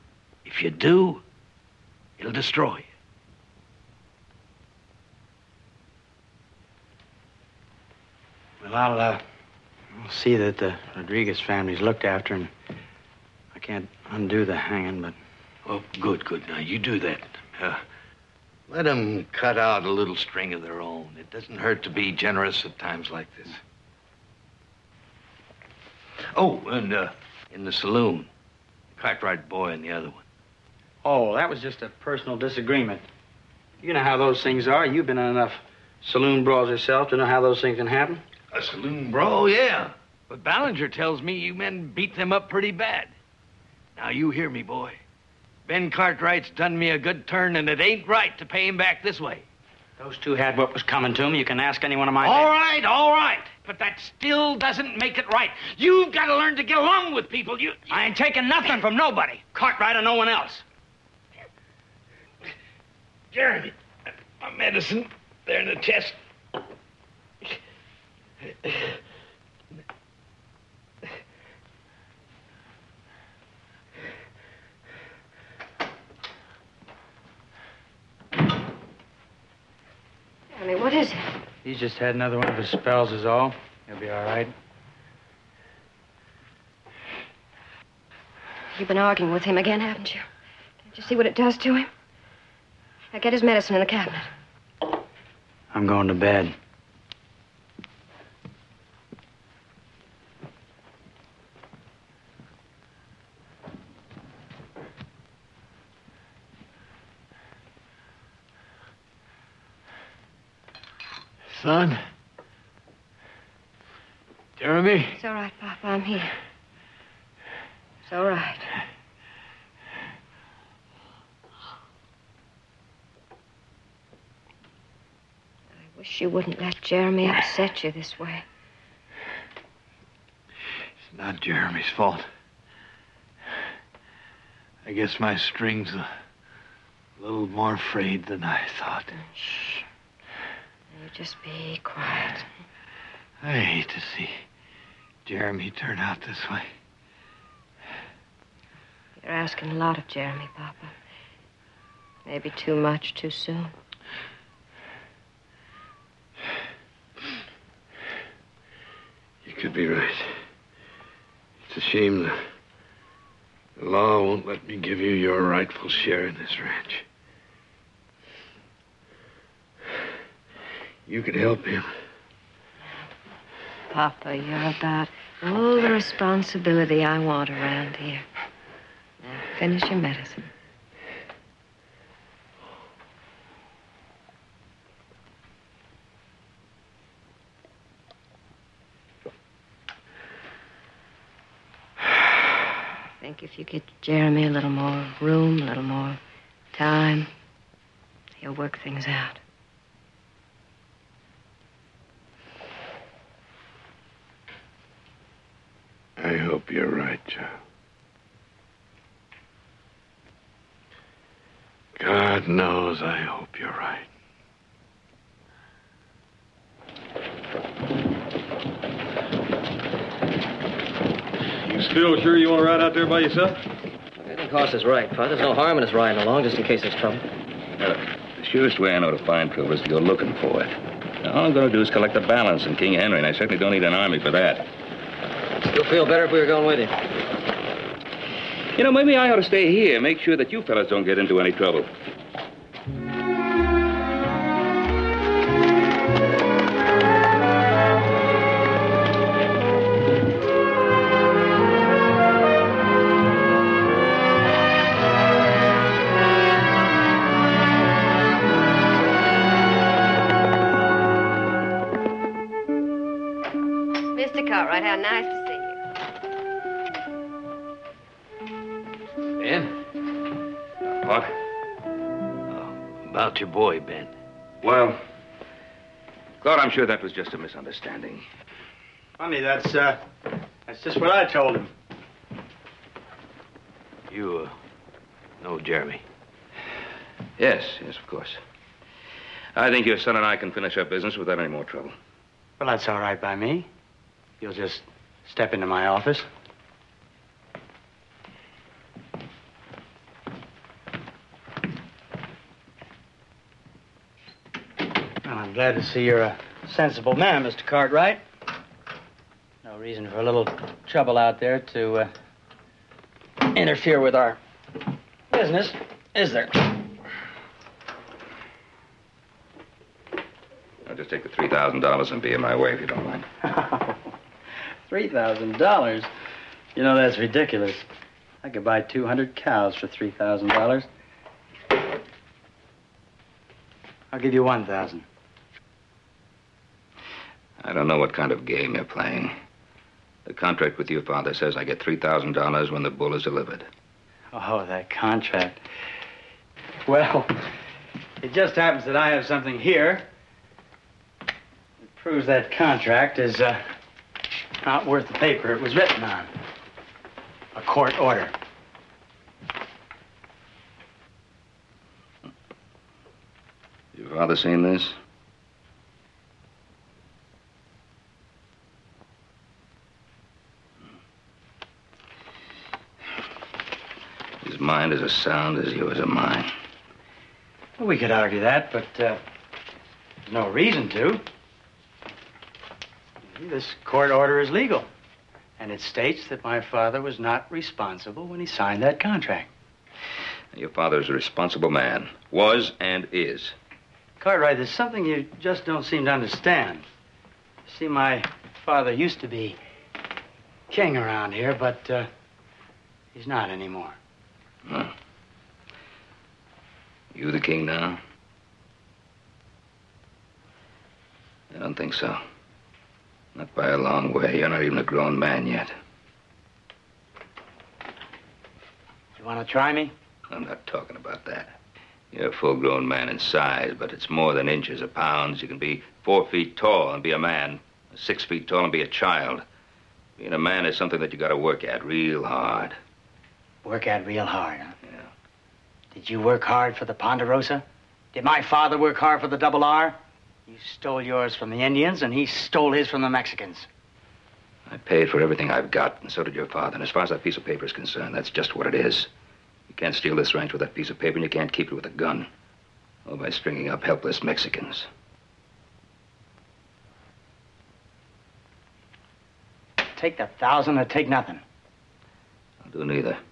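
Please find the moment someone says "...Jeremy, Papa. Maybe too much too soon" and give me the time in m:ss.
2:30.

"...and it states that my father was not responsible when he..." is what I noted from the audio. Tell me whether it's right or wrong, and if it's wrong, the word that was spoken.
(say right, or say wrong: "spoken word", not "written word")
right.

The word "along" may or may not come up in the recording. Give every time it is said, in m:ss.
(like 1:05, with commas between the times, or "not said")
0:56, 3:46.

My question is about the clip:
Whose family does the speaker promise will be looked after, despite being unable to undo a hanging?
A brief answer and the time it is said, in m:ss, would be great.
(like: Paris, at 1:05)
Rodriguez, at 0:10.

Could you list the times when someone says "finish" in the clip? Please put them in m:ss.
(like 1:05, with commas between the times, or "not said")
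2:59, 4:50.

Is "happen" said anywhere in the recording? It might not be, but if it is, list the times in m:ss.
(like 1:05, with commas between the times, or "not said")
0:37, 5:48.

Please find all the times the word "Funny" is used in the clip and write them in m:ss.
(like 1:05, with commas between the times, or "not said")
4:39.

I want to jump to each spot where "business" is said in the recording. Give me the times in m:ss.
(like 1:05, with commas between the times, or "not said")
4:50, 5:15.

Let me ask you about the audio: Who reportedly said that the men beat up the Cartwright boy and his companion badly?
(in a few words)
Ballinger.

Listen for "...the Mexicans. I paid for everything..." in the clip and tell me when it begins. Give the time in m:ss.
7:23.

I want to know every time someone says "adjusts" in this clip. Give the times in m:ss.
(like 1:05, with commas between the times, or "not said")
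not said.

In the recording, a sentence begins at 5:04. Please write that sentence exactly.
Well, I'm glad to see you're a uh, sensible man, Mr.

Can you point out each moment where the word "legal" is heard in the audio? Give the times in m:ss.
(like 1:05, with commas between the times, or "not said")
6:24.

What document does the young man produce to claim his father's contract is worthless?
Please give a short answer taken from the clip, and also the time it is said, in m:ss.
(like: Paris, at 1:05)
A court order, at 5:57.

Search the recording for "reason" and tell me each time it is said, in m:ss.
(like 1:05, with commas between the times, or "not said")
5:09, 6:20.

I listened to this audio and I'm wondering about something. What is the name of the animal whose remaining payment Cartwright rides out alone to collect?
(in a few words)
King Henry.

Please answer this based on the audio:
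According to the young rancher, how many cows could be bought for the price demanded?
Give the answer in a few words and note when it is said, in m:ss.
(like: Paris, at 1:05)
200, at 5:28.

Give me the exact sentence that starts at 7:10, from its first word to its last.
Being a man is something that you got to work at real hard.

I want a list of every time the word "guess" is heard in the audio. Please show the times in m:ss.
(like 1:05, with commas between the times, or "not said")
2:14.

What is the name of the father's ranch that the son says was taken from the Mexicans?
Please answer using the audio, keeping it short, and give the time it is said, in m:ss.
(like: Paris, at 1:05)
Double R, at 7:19.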